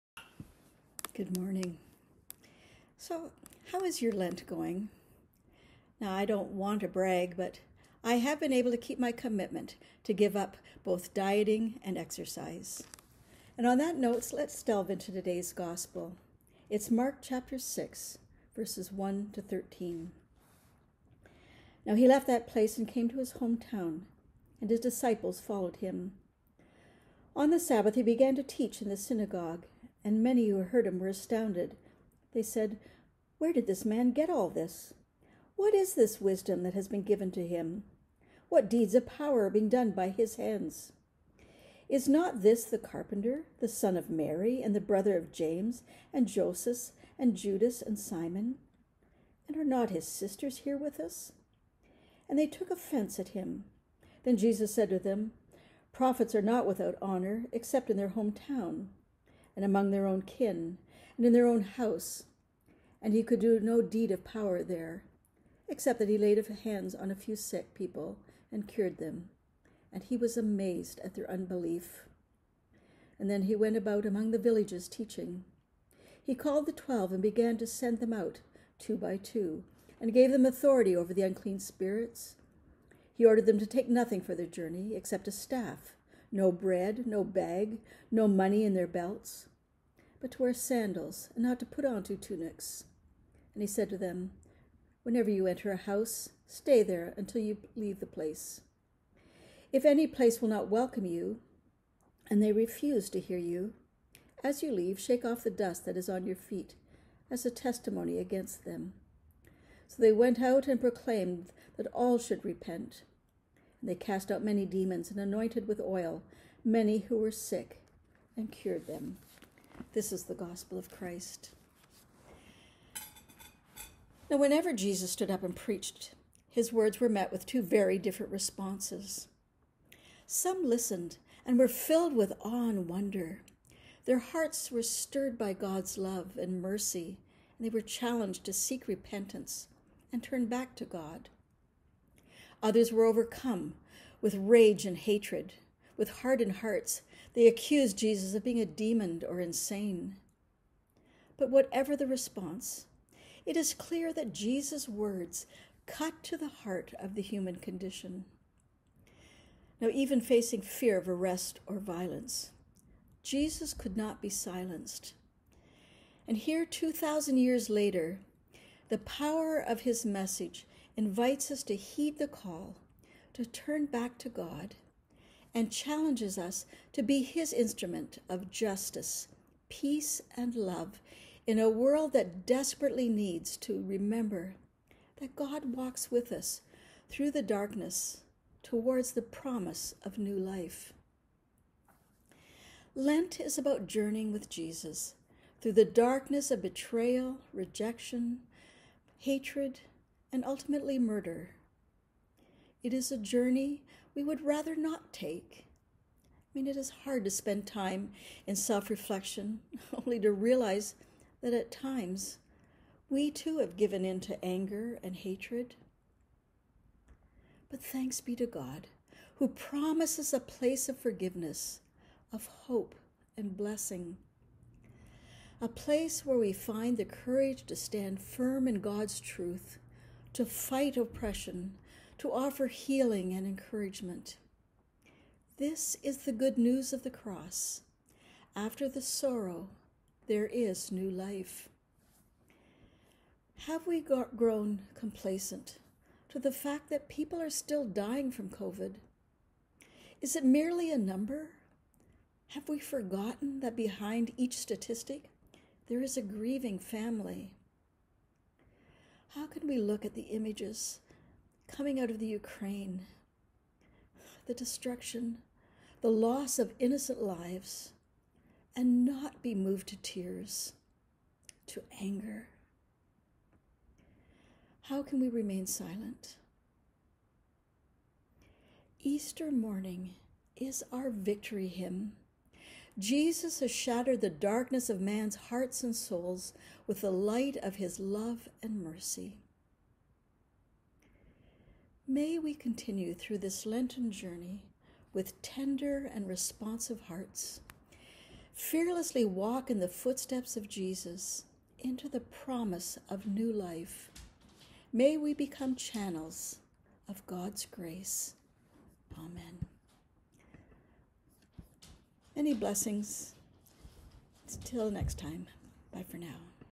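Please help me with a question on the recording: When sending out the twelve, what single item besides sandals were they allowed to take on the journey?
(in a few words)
A staff.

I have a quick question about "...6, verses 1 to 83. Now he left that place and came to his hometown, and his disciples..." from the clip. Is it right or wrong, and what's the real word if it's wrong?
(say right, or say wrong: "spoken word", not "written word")
wrong: "13", not "83".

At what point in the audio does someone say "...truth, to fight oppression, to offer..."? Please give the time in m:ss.
3:49.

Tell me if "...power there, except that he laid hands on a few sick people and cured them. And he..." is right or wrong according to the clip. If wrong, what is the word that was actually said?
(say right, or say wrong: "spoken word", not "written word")
right.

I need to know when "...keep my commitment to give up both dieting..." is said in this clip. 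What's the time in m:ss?
0:08.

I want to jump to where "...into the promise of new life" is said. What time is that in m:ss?
5:01.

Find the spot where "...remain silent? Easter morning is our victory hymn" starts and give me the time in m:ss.
4:35.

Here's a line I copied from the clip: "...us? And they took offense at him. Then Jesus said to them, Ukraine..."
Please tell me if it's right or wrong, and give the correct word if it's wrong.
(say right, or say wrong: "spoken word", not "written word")
wrong: "Prophets", not "Ukraine".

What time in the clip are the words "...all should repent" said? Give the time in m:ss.
1:51.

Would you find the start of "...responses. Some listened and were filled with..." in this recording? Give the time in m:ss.
2:08.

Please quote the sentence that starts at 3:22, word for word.
It is a journey we would rather not take.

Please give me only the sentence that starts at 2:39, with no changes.
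Now, even facing fear of arrest or violence, Jesus could not be silenced.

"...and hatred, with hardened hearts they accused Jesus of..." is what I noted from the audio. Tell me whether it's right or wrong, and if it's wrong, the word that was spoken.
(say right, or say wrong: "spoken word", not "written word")
right.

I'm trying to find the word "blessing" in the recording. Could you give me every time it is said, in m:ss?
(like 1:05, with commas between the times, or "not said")
3:43, 5:12.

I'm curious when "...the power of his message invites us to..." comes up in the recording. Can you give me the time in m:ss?
2:48.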